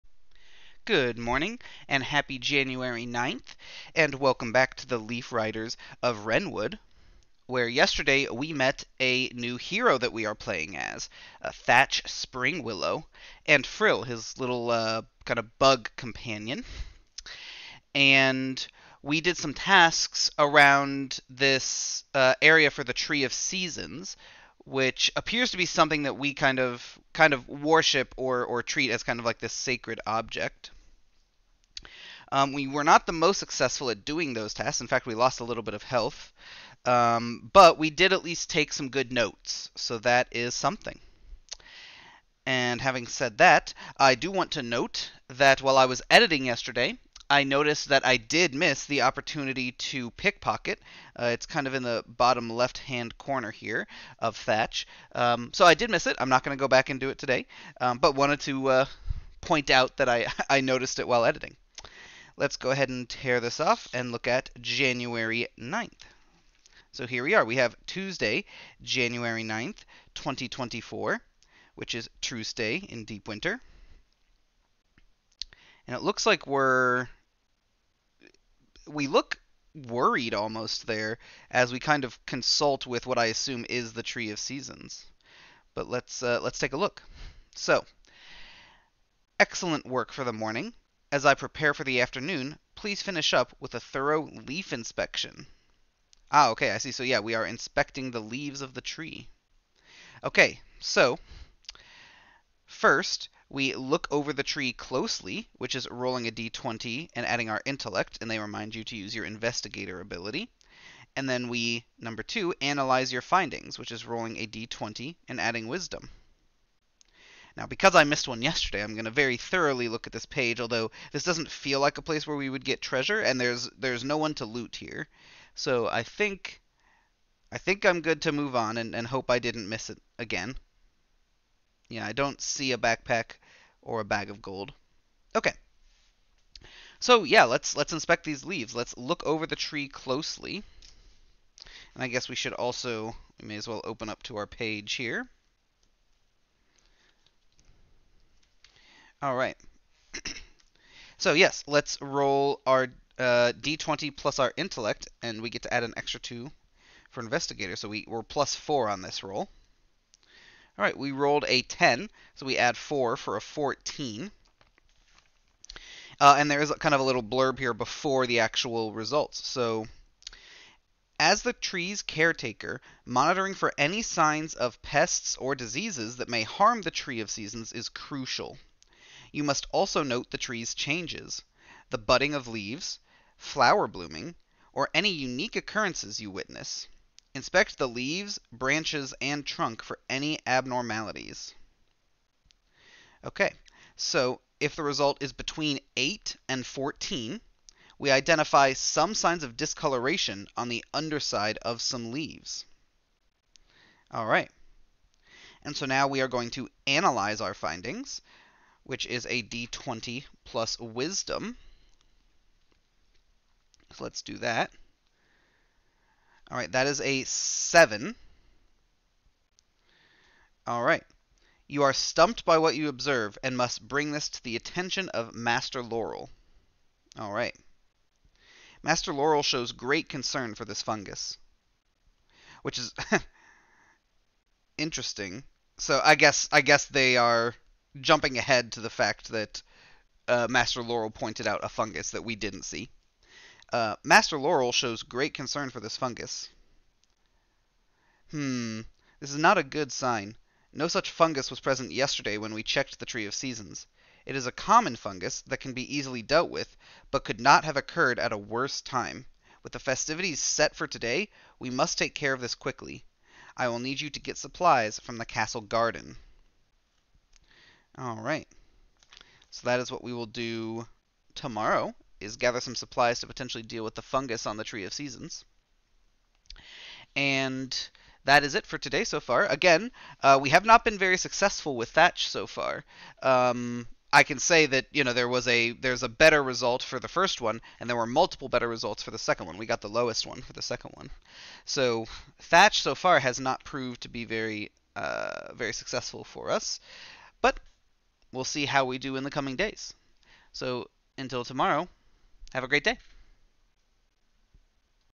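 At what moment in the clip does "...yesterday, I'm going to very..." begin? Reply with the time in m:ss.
1:58.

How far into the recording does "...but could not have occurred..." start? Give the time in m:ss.
4:17.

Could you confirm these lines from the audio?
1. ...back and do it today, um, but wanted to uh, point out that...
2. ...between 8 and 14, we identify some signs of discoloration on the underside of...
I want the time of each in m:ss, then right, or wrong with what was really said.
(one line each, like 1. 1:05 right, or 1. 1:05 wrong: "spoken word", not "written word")
1. 0:56 right
2. 3:15 right.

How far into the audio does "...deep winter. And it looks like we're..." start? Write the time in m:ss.
1:13.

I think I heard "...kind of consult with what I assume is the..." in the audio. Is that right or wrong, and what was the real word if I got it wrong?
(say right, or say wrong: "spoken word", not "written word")
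right.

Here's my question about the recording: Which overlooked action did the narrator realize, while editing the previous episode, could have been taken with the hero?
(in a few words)
pickpocket.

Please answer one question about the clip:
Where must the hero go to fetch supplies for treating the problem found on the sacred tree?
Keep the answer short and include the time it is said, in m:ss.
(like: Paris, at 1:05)
castle garden, at 4:25.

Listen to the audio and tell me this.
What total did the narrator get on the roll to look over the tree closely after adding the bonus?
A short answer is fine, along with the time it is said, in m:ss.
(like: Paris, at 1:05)
14, at 2:43.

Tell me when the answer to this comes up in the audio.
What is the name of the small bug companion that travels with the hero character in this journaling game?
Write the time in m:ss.
0:13.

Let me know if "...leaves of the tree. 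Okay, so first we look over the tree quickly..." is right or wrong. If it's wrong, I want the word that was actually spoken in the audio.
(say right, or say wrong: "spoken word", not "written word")
wrong: "closely", not "quickly".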